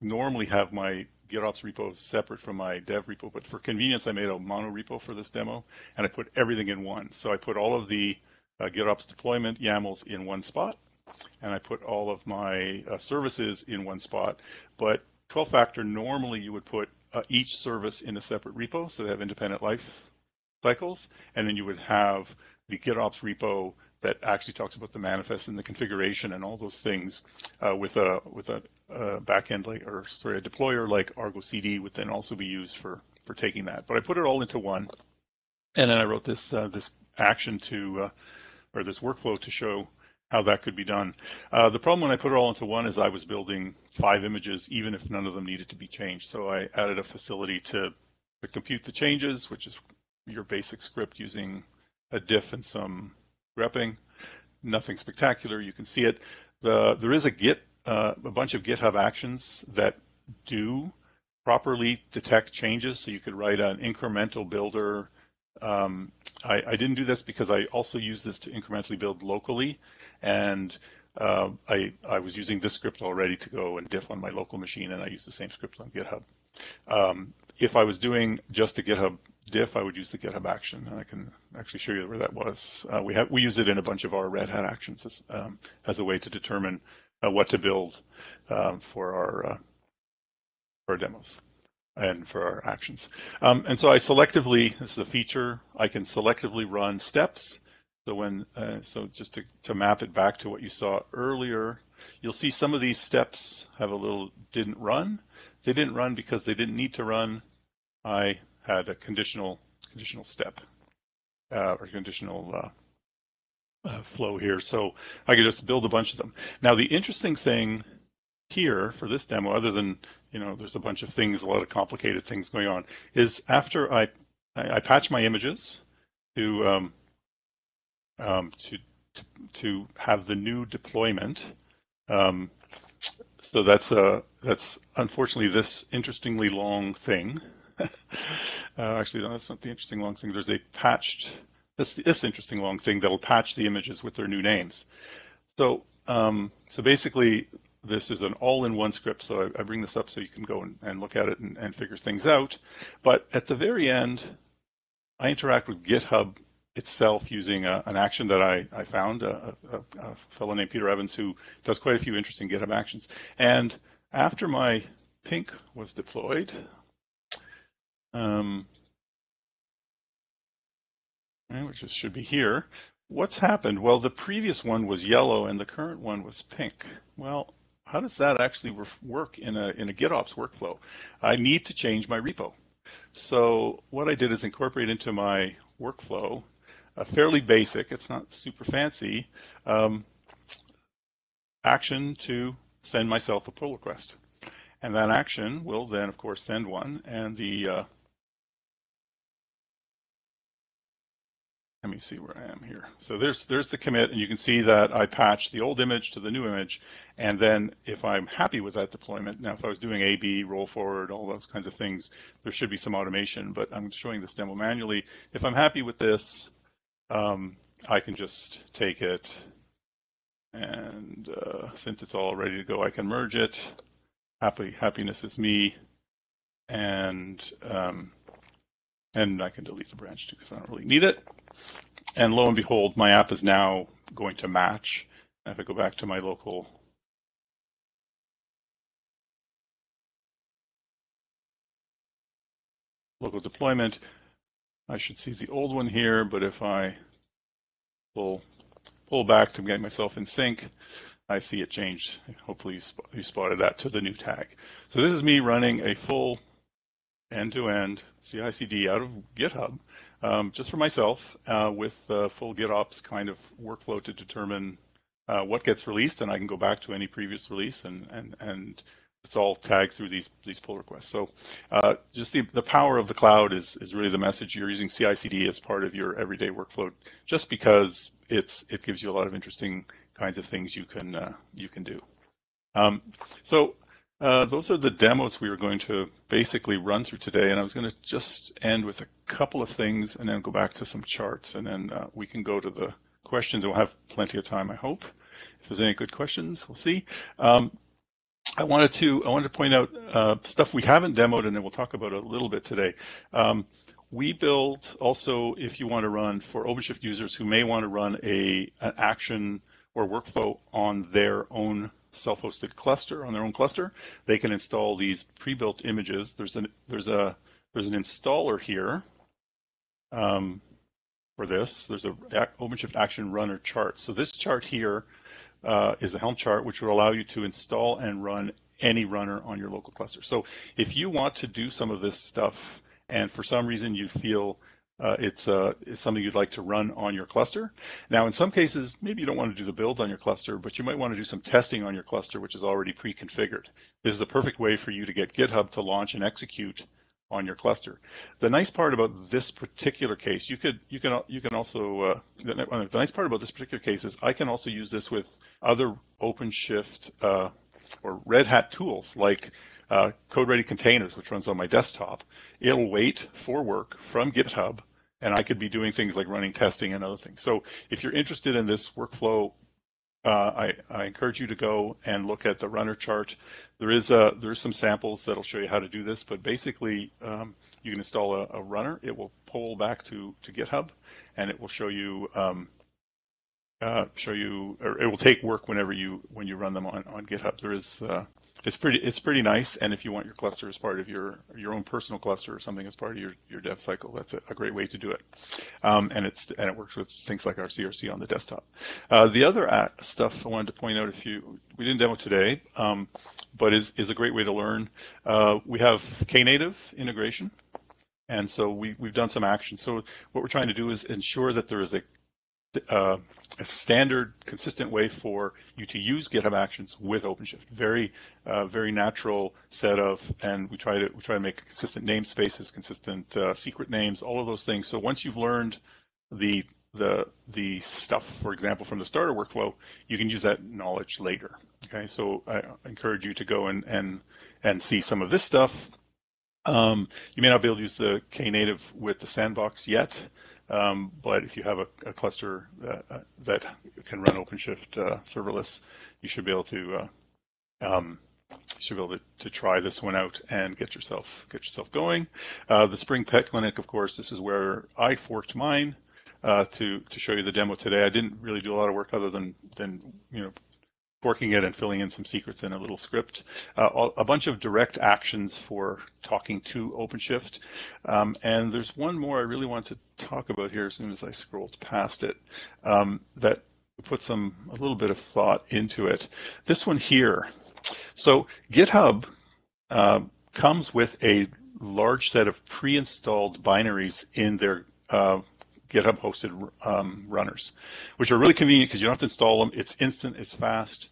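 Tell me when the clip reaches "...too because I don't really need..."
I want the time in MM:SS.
03:50.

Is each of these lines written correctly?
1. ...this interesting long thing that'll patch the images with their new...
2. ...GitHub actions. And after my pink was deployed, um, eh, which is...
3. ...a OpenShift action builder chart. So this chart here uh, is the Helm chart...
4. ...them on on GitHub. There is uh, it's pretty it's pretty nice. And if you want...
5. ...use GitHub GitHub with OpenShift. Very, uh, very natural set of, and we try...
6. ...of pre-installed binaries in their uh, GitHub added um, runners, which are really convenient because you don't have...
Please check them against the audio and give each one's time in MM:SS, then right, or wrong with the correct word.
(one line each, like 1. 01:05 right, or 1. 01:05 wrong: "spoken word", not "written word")
1. 02:21 right
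2. 02:42 right
3. 05:22 wrong: "runner", not "builder"
4. 06:26 right
5. 06:55 wrong: "Actions", not "GitHub"
6. 08:02 wrong: "hosted", not "added".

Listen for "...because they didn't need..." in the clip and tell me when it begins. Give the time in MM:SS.
01:46.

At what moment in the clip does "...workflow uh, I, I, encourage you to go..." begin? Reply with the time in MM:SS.
06:08.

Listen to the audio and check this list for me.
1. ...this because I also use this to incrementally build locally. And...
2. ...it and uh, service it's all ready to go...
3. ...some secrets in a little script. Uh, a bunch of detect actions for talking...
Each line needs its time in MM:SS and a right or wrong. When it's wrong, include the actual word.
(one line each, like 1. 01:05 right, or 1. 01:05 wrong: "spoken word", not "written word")
1. 01:07 right
2. 03:39 wrong: "since", not "service"
3. 07:42 wrong: "direct", not "detect".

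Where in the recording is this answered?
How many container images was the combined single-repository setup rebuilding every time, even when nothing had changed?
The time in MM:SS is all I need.
00:43.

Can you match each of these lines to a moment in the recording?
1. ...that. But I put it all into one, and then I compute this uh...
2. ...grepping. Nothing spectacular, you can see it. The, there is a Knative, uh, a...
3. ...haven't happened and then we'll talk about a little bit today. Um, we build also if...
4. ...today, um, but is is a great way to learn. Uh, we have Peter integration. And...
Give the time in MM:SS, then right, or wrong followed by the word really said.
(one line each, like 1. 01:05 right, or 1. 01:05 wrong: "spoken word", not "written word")
1. 00:33 wrong: "wrote", not "compute"
2. 00:53 wrong: "Git", not "Knative"
3. 05:00 wrong: "demoed", not "happened"
4. 06:42 wrong: "Knative", not "Peter".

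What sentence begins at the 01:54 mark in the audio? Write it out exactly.
So I could just build a bunch of them.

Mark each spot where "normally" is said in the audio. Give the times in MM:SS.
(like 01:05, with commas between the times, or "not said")
00:00, 00:15.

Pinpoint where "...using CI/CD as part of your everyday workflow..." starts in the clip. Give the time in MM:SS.
04:34.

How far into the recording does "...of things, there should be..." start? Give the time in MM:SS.
03:31.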